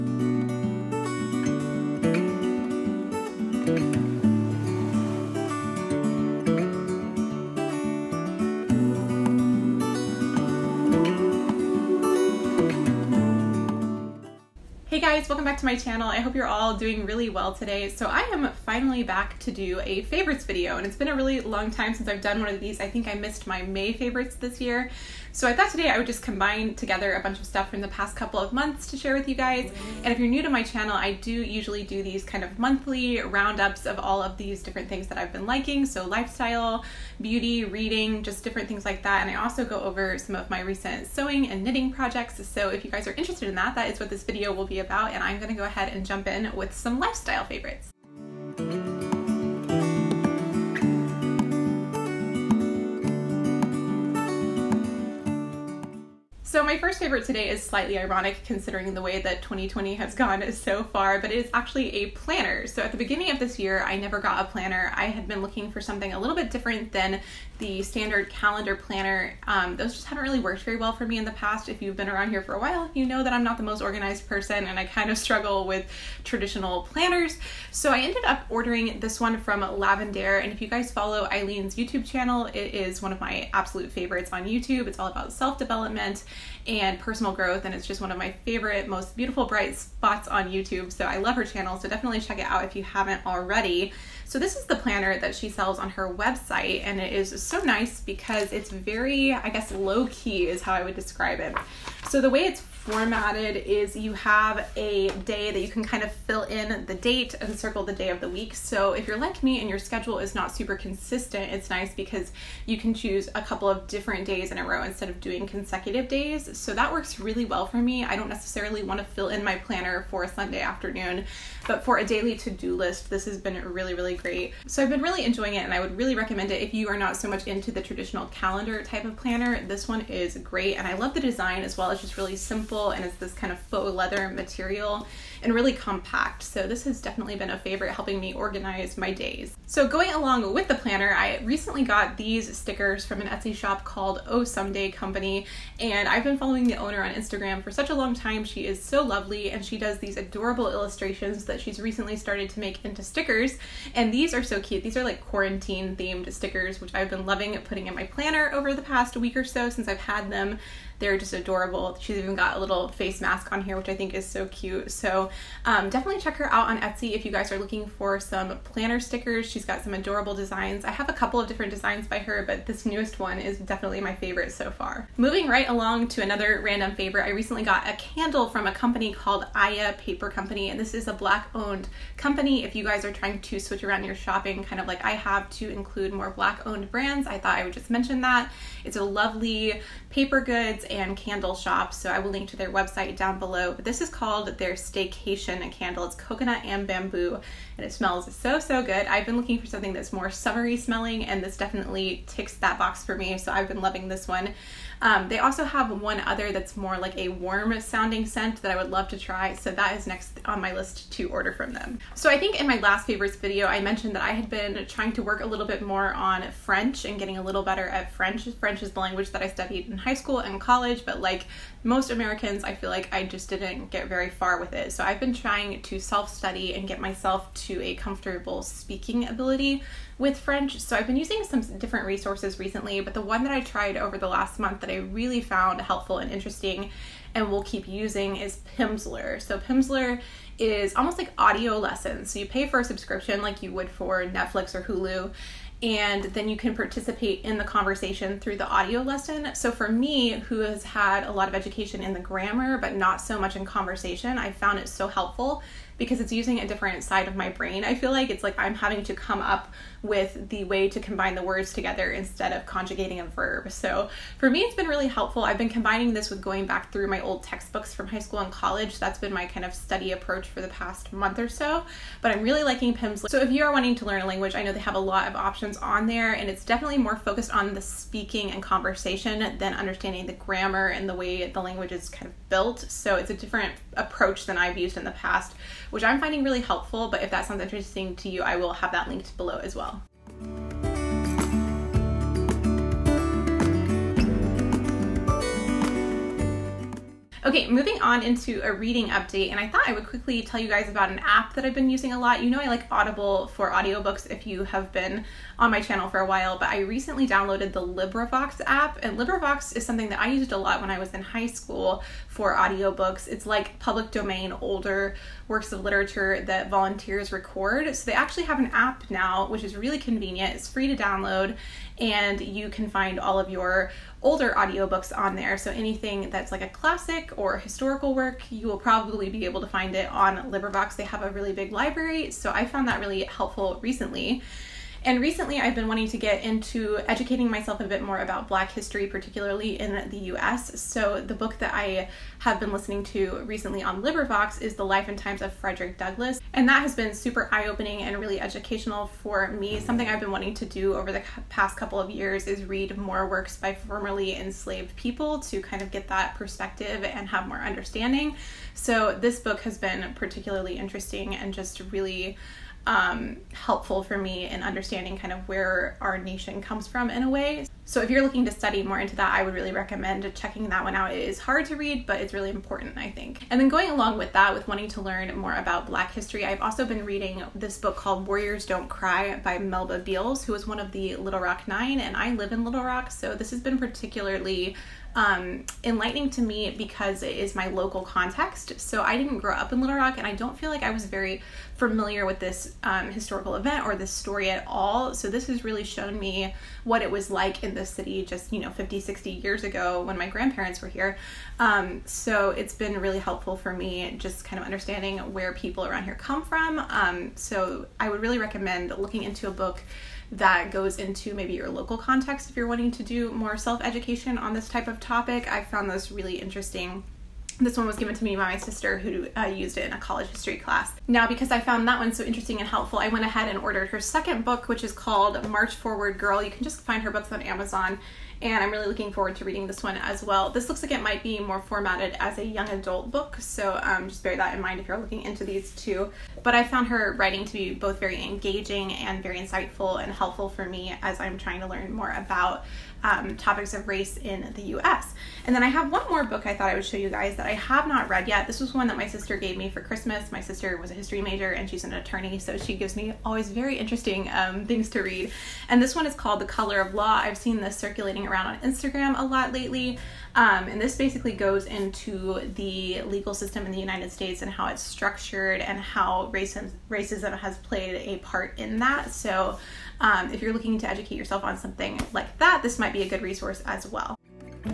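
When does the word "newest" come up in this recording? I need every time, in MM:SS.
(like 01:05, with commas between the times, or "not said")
02:52.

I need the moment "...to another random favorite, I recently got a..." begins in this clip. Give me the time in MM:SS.
02:56.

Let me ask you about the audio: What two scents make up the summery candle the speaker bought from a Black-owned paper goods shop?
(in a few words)
Coconut and bamboo.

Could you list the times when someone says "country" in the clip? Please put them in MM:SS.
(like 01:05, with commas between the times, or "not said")
not said.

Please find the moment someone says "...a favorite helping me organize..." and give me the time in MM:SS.
02:17.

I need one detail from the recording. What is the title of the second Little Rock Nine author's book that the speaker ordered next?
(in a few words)
March Forward Girl.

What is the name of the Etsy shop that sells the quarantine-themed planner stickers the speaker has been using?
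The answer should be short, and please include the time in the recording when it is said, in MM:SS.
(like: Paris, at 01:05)
Oh Someday Company, at 02:24.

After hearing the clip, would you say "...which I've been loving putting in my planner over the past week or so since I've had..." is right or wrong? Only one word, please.
right.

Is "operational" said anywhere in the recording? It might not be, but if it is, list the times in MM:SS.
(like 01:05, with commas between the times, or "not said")
not said.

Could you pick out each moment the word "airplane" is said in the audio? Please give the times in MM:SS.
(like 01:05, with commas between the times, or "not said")
not said.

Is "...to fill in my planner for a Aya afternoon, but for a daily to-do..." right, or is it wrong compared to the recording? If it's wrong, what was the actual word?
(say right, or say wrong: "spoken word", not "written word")
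wrong: "Sunday", not "Aya".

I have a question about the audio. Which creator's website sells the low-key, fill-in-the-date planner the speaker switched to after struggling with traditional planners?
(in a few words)
Lavendaire.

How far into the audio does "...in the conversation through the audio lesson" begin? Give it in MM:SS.
04:07.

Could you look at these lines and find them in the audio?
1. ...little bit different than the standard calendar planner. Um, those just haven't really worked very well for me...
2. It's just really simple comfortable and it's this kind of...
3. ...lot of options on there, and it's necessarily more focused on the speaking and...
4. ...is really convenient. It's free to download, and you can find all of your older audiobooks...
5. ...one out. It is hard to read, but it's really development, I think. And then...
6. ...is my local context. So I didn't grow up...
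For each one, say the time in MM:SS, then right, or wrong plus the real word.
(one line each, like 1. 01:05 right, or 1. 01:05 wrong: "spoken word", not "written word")
1. 01:06 right
2. 02:11 right
3. 04:34 wrong: "definitely", not "necessarily"
4. 05:19 right
5. 06:10 wrong: "important", not "development"
6. 06:27 right.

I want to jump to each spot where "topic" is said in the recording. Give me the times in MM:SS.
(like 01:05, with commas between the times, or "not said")
06:54, 07:23.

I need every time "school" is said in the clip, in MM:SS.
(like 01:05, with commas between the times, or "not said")
03:40, 04:28, 05:11.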